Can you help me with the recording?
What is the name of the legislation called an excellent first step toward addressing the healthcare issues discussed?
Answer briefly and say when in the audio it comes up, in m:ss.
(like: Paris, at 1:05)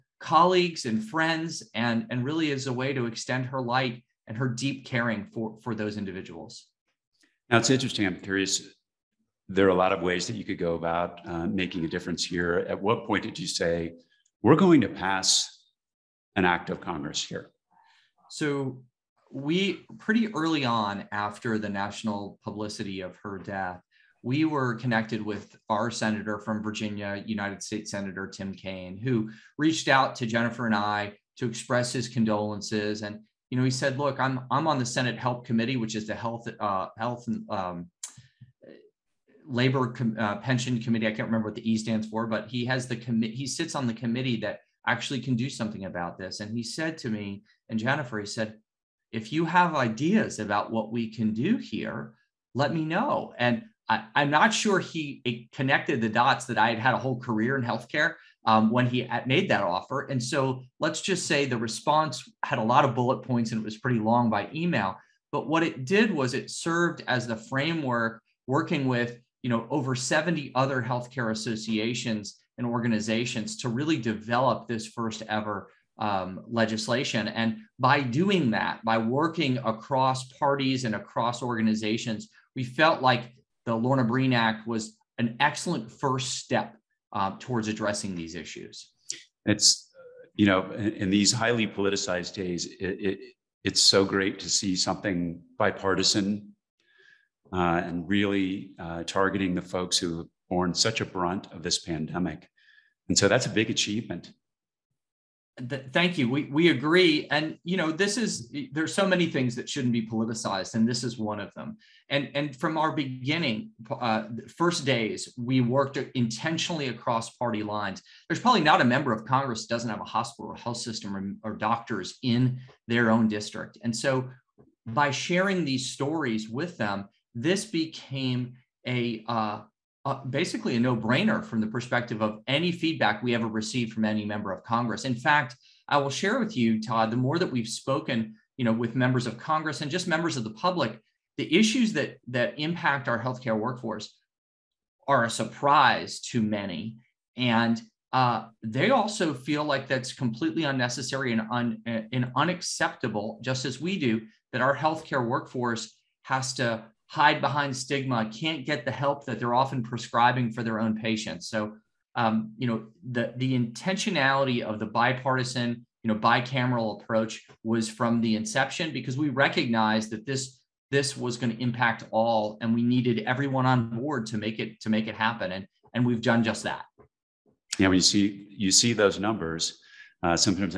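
Lorna Breen Act, at 1:23.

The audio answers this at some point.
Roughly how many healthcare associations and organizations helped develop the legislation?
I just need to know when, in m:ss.
1:09.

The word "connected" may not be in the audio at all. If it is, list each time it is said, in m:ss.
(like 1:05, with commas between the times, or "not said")
0:24, 0:55.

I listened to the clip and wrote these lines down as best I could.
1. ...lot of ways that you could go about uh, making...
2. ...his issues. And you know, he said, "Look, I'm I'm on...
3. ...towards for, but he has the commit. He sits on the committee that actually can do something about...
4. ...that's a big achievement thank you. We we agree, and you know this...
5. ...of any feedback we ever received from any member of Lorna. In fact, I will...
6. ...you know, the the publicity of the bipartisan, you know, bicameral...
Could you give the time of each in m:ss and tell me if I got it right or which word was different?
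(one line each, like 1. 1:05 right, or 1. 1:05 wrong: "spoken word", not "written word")
1. 0:09 right
2. 0:31 wrong: "condolences", not "issues"
3. 0:41 wrong: "stands", not "towards"
4. 1:43 right
5. 2:12 wrong: "Congress", not "Lorna"
6. 2:42 wrong: "intentionality", not "publicity".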